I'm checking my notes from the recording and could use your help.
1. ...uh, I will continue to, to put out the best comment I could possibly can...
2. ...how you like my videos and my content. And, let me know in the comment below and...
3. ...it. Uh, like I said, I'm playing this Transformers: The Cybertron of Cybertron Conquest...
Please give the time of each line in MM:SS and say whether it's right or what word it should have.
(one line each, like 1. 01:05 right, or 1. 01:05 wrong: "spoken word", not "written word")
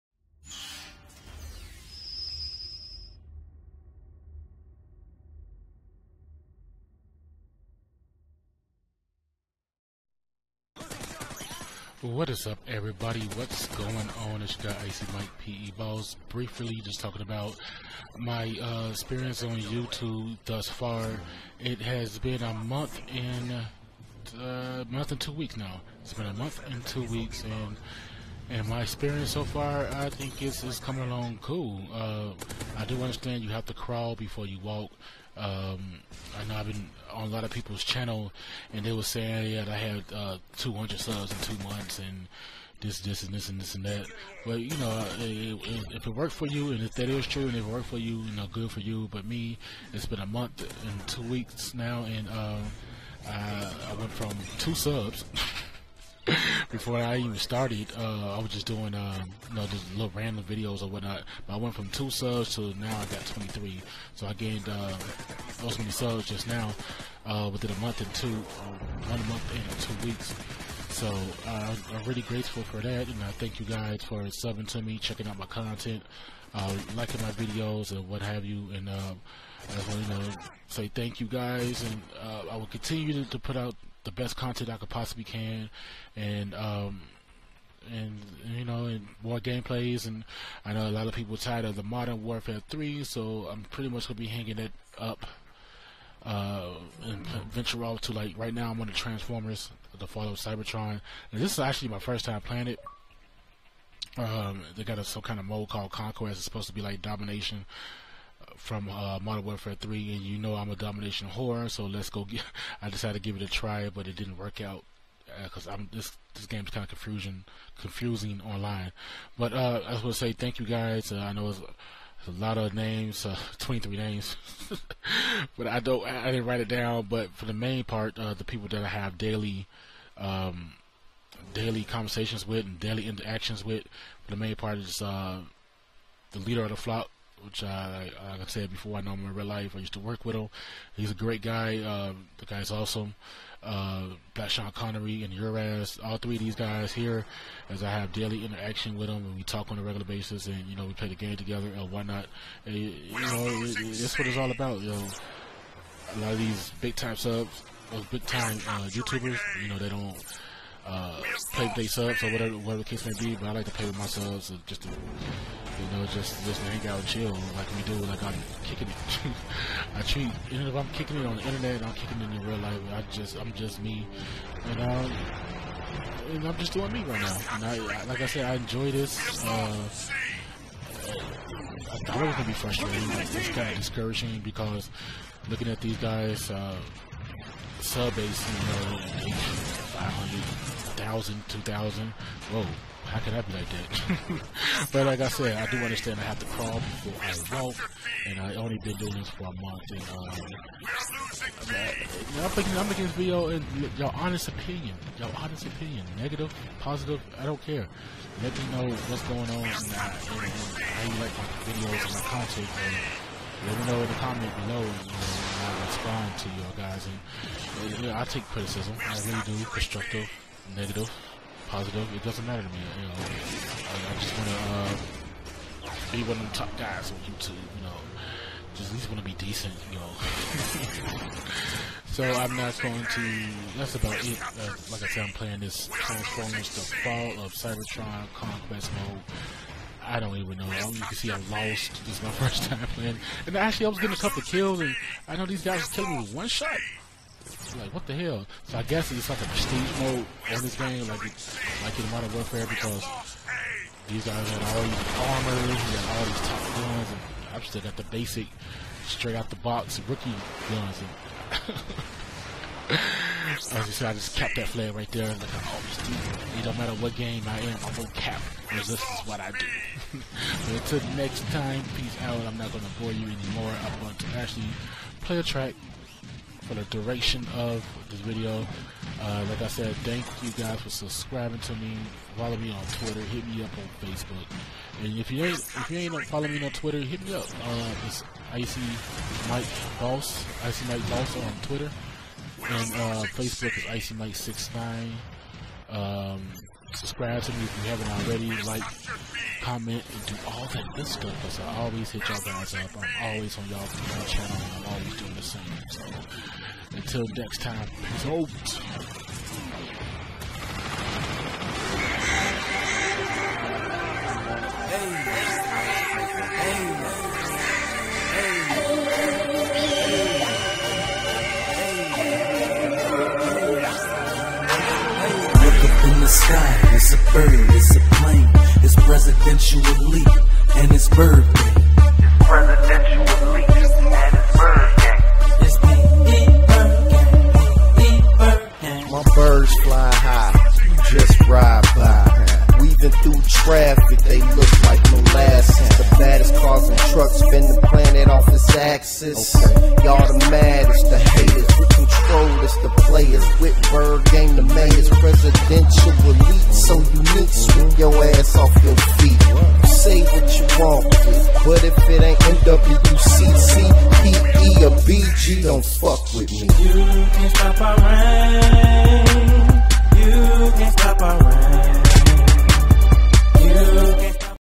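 1. 01:22 wrong: "content", not "comment"
2. 03:30 right
3. 03:54 wrong: "Fall", not "Cybertron".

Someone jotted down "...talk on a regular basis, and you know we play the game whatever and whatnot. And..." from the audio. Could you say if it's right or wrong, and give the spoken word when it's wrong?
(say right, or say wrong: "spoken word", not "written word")
wrong: "together", not "whatever".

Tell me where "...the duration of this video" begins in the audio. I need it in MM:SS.
04:36.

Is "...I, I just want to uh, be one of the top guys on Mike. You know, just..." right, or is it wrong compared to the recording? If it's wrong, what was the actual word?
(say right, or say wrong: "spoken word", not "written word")
wrong: "YouTube", not "Mike".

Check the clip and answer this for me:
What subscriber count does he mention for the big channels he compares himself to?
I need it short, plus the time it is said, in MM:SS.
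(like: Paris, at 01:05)
500,000, at 03:09.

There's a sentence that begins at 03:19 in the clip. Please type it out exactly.
And uh, um, I, I'm, making, I'm making this video and y'all honest opinion, y'all honest opinion, negative, positive, I don't care.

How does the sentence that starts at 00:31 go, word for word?
Uh, I do understand you have to crawl before you walk.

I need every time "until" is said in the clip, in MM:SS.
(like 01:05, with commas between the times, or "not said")
04:30, 05:06.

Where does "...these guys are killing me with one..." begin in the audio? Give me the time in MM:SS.
04:05.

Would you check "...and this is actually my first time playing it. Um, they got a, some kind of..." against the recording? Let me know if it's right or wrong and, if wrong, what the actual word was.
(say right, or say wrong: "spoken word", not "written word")
right.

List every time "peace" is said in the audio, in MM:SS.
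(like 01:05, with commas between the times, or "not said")
04:31, 05:07.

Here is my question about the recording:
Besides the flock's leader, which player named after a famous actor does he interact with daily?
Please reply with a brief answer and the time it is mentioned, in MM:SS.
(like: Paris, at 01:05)
Black Sean Connery, at 02:24.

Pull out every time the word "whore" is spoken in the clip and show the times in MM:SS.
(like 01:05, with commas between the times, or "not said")
01:51.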